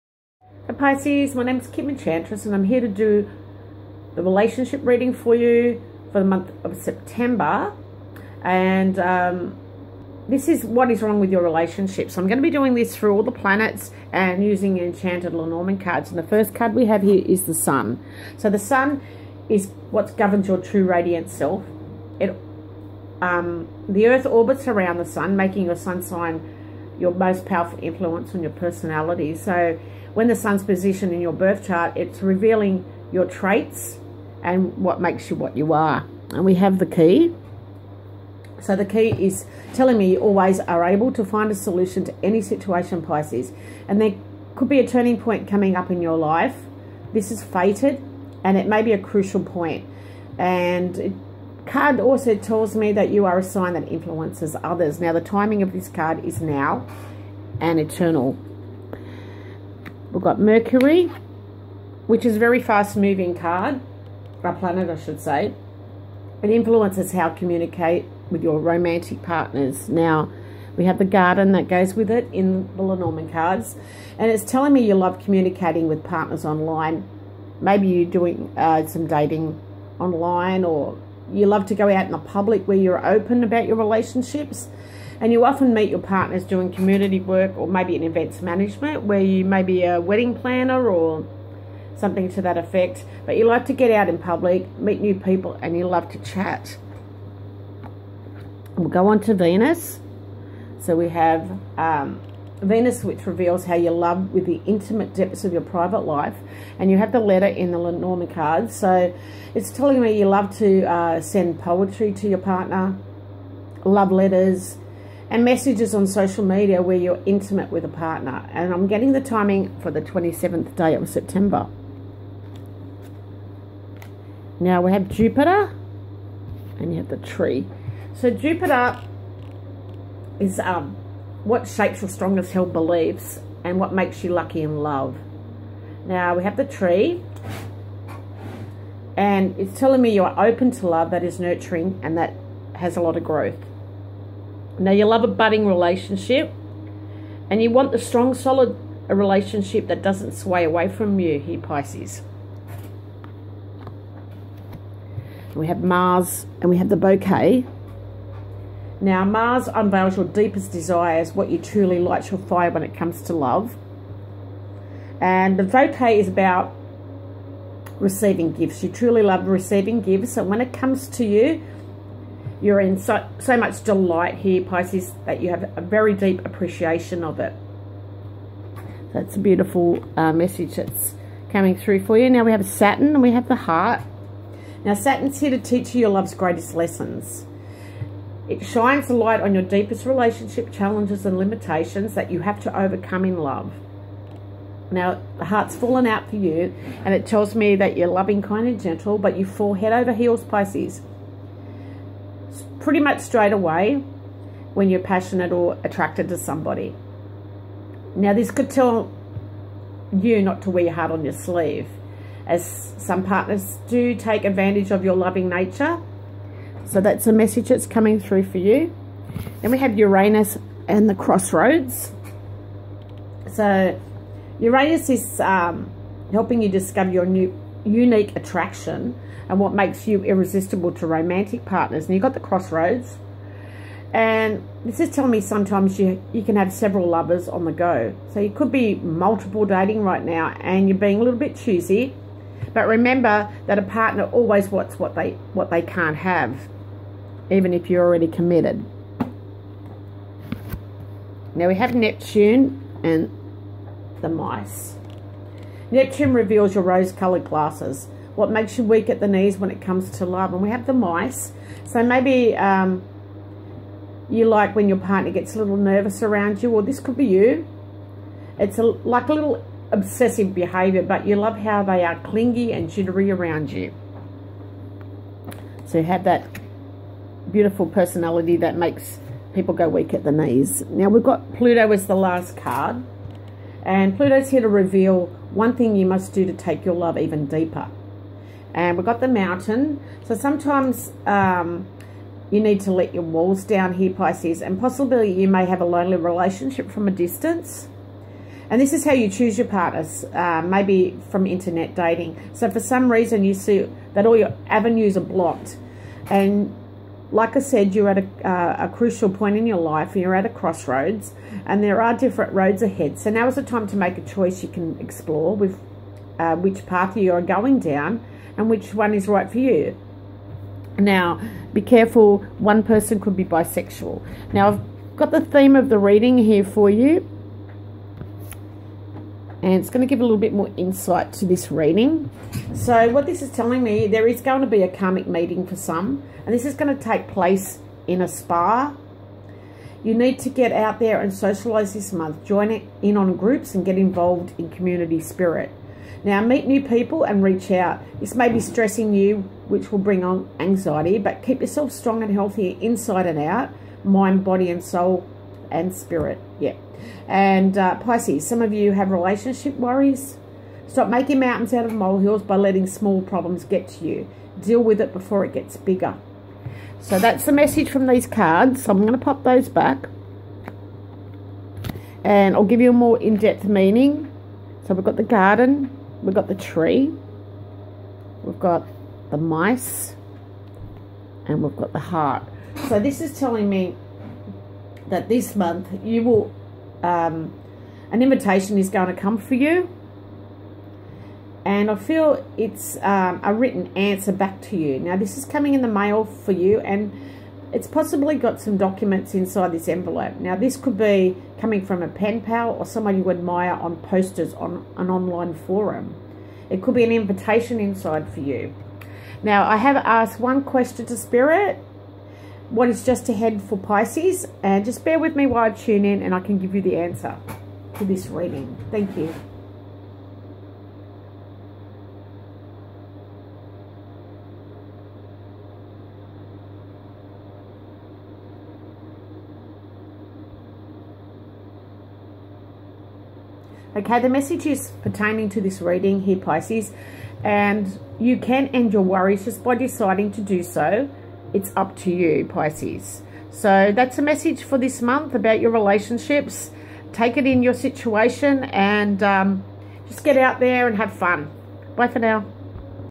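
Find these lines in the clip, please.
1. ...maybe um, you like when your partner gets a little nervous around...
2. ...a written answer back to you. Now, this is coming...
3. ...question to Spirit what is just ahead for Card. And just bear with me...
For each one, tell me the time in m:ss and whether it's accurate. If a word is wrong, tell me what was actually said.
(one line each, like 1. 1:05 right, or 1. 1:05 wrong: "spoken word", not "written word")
1. 4:22 right
2. 6:33 right
3. 6:50 wrong: "Pisces", not "Card".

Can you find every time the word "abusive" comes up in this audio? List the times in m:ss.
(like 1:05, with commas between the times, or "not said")
not said.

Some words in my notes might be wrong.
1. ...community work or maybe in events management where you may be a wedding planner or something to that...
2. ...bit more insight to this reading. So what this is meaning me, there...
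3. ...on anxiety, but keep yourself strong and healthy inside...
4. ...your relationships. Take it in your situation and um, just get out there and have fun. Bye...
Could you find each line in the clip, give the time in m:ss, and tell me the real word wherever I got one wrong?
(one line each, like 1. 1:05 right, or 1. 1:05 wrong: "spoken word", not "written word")
1. 1:26 right
2. 5:30 wrong: "telling", not "meaning"
3. 5:50 right
4. 7:25 right.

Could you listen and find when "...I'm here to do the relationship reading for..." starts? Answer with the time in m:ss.
0:02.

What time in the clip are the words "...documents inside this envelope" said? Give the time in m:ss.
6:38.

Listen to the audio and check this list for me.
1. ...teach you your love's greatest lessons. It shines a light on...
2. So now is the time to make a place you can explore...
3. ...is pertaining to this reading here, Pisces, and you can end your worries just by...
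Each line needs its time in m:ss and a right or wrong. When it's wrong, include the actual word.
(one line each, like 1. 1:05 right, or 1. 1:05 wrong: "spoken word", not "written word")
1. 3:05 right
2. 5:13 wrong: "choice", not "place"
3. 7:14 right.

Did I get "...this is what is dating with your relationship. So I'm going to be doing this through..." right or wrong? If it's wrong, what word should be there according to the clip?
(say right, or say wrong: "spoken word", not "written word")
wrong: "wrong", not "dating".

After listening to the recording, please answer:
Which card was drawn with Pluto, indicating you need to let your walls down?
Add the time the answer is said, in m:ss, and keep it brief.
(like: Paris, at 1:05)
The mountain, at 4:49.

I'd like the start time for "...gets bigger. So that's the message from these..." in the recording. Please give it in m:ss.
6:05.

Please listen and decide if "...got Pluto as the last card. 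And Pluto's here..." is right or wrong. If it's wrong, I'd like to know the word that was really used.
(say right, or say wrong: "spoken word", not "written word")
right.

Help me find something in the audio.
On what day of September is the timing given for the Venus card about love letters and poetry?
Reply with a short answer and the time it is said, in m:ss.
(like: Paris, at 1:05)
27th, at 2:00.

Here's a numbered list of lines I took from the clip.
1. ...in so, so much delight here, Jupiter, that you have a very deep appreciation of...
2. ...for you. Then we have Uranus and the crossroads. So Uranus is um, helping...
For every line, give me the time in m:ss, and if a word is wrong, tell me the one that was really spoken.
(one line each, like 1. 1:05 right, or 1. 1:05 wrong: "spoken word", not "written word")
1. 2:52 wrong: "Pisces", not "Jupiter"
2. 3:38 right.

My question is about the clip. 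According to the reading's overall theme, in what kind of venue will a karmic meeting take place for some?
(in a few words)
A spa.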